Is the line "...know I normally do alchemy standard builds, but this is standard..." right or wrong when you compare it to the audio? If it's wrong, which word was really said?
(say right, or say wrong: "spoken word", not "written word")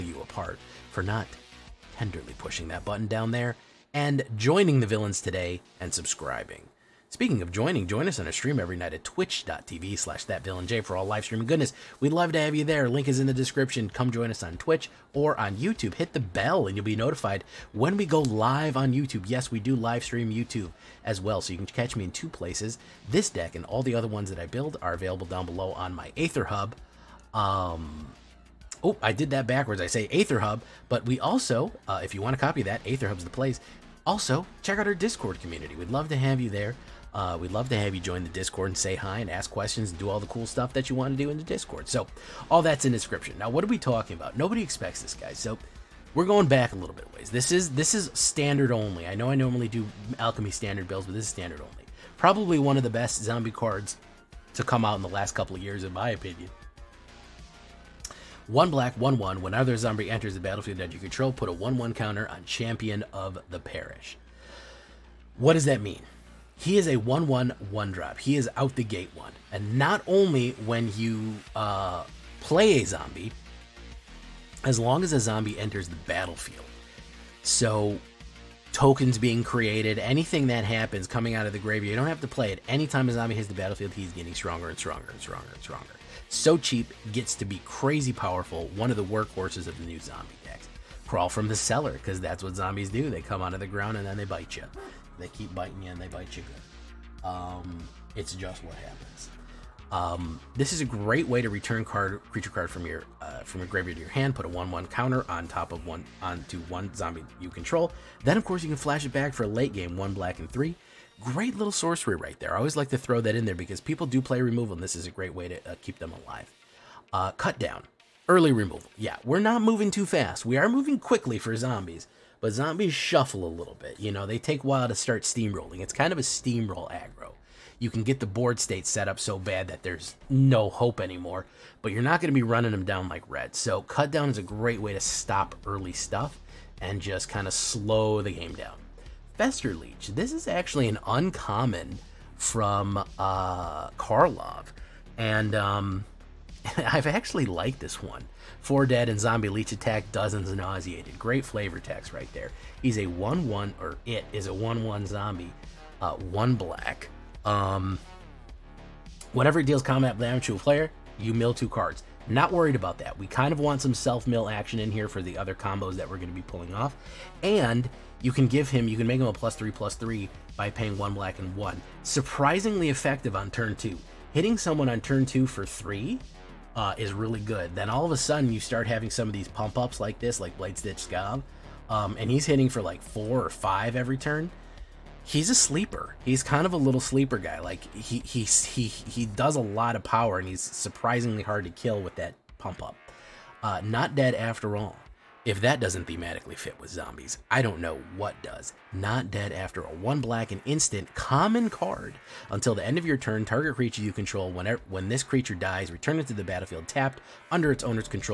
right.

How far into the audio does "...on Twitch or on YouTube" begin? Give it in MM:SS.
00:14.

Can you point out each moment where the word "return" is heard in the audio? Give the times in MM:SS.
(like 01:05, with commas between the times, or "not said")
01:41, 03:25.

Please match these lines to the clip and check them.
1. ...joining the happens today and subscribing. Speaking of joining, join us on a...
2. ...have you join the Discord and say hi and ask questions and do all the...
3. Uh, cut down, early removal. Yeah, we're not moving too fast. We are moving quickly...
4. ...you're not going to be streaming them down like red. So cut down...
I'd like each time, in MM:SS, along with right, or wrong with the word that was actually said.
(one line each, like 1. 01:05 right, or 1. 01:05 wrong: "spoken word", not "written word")
1. 00:04 wrong: "villains", not "happens"
2. 00:37 right
3. 01:57 right
4. 02:11 wrong: "running", not "streaming".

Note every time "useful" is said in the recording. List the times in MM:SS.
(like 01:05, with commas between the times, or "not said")
not said.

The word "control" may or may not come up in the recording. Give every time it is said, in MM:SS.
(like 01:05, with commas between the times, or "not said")
01:00, 01:47, 03:24.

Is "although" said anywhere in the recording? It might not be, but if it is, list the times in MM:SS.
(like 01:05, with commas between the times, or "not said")
not said.